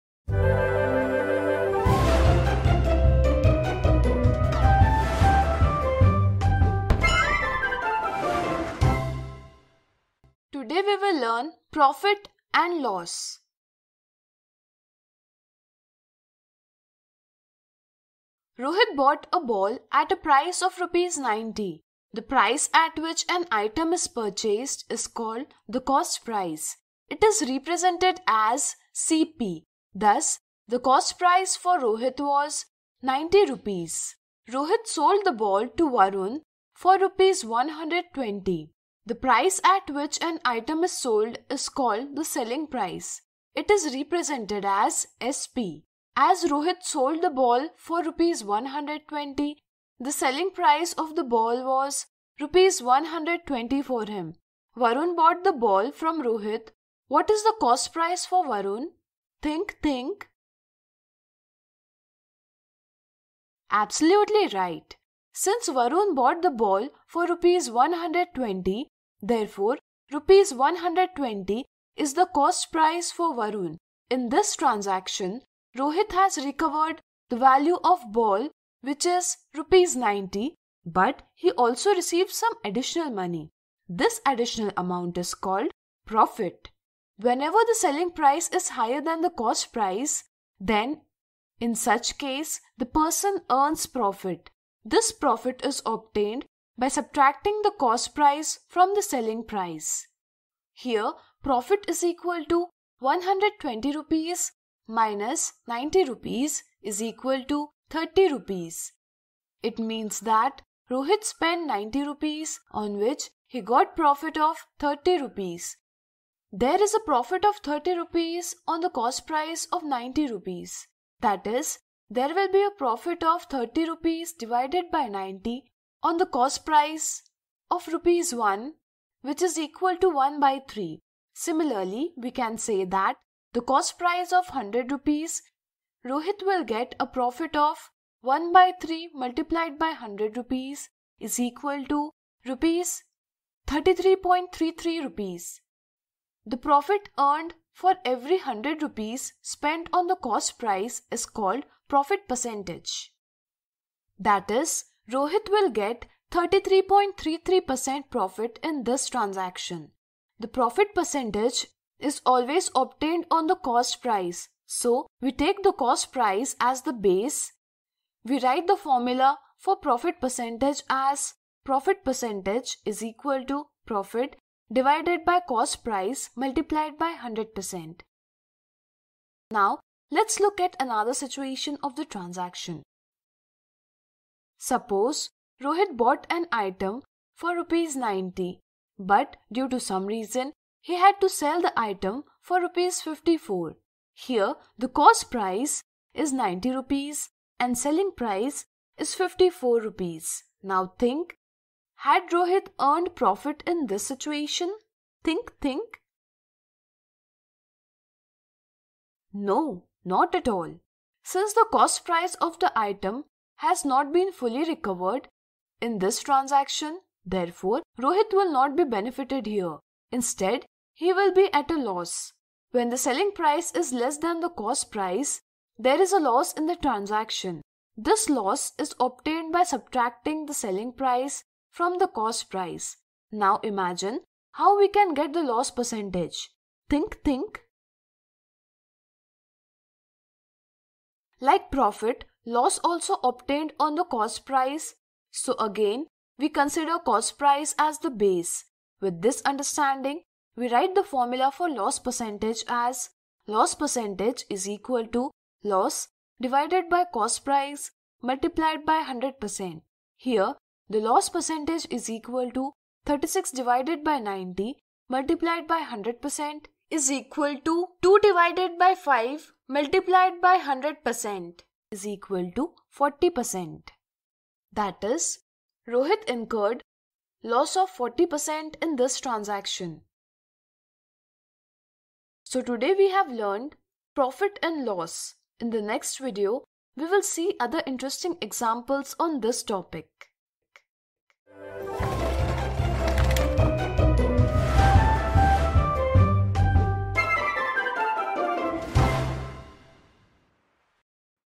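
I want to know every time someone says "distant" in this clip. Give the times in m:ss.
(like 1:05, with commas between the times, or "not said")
not said.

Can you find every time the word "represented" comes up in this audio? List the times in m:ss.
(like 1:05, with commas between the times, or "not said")
0:27, 0:43.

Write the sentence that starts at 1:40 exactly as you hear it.
Here, profit is equal to 120 rupees minus 90 rupees is equal to 30 rupees.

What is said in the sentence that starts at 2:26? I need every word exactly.
The profit earned for every 100 rupees spent on the cost price is called profit percentage.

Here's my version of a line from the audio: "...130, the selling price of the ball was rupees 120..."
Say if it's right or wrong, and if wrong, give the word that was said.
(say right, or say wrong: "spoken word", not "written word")
wrong: "120", not "130".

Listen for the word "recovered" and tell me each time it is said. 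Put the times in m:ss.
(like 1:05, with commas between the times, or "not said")
1:16, 3:34.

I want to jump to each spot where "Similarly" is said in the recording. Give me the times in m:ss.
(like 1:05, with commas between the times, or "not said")
2:11.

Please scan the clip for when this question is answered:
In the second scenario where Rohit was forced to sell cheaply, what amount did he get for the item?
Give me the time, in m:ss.
3:12.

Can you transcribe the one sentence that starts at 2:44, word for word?
So, we take the cost price as the base.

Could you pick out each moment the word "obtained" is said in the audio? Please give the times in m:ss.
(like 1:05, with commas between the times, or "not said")
1:35, 2:42, 3:48, 4:03.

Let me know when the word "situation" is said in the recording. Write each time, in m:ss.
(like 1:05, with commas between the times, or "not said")
3:01, 3:24.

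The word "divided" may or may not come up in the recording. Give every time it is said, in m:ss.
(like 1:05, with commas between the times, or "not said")
2:04, 2:54, 4:16, 4:23, 4:28.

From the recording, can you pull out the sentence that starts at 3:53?
Now imagine how we can get the loss percentage.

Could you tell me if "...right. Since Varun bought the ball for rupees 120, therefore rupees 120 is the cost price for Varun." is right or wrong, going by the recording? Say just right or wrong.
right.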